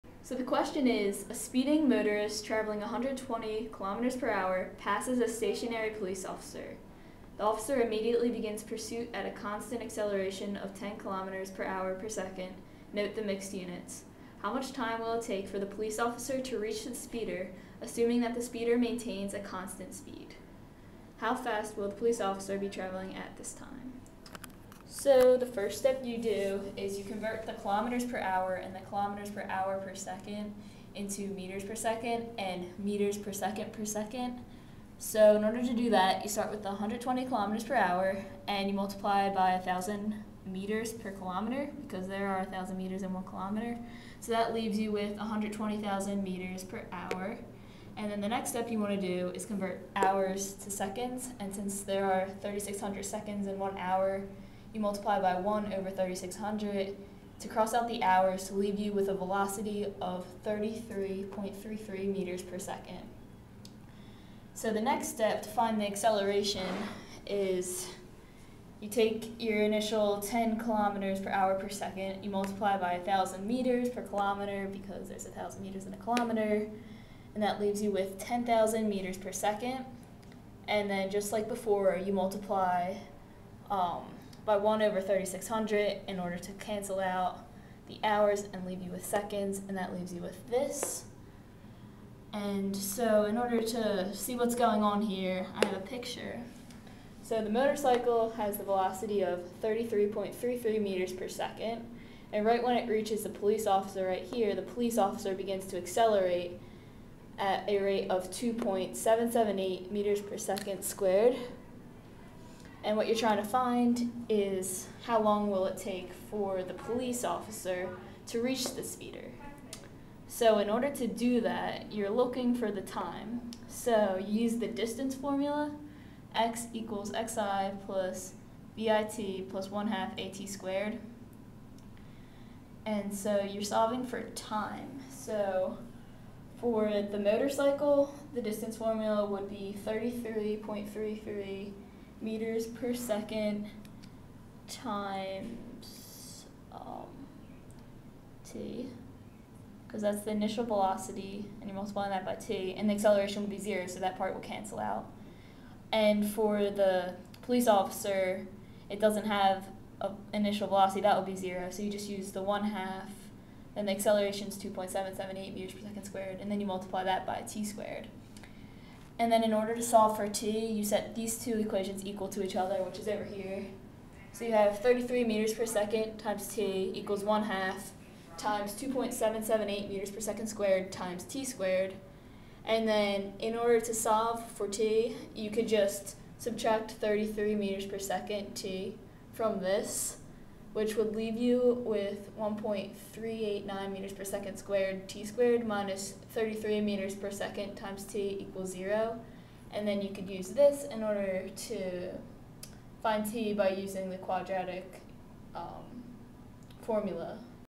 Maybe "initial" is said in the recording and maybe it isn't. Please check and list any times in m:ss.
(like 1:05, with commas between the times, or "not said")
1:09, 2:30, 2:40.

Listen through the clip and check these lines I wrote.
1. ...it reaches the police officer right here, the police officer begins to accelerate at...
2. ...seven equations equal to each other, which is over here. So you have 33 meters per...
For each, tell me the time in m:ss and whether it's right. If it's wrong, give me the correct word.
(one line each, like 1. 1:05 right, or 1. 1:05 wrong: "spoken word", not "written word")
1. 1:42 right
2. 2:51 wrong: "two", not "seven".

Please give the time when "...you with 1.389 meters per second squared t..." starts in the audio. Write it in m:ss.
3:11.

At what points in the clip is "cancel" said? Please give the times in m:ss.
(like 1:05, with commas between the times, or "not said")
1:26, 2:34.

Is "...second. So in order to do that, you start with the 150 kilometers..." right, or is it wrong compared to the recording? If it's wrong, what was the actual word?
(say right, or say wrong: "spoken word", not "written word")
wrong: "120", not "150".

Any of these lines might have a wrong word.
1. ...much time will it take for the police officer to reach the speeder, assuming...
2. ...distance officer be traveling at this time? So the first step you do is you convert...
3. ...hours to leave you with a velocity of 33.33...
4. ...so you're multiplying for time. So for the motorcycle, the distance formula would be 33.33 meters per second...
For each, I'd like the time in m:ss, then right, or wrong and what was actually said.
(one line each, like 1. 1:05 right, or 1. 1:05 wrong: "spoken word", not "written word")
1. 0:14 right
2. 0:21 wrong: "police", not "distance"
3. 0:58 right
4. 2:13 wrong: "solving", not "multiplying".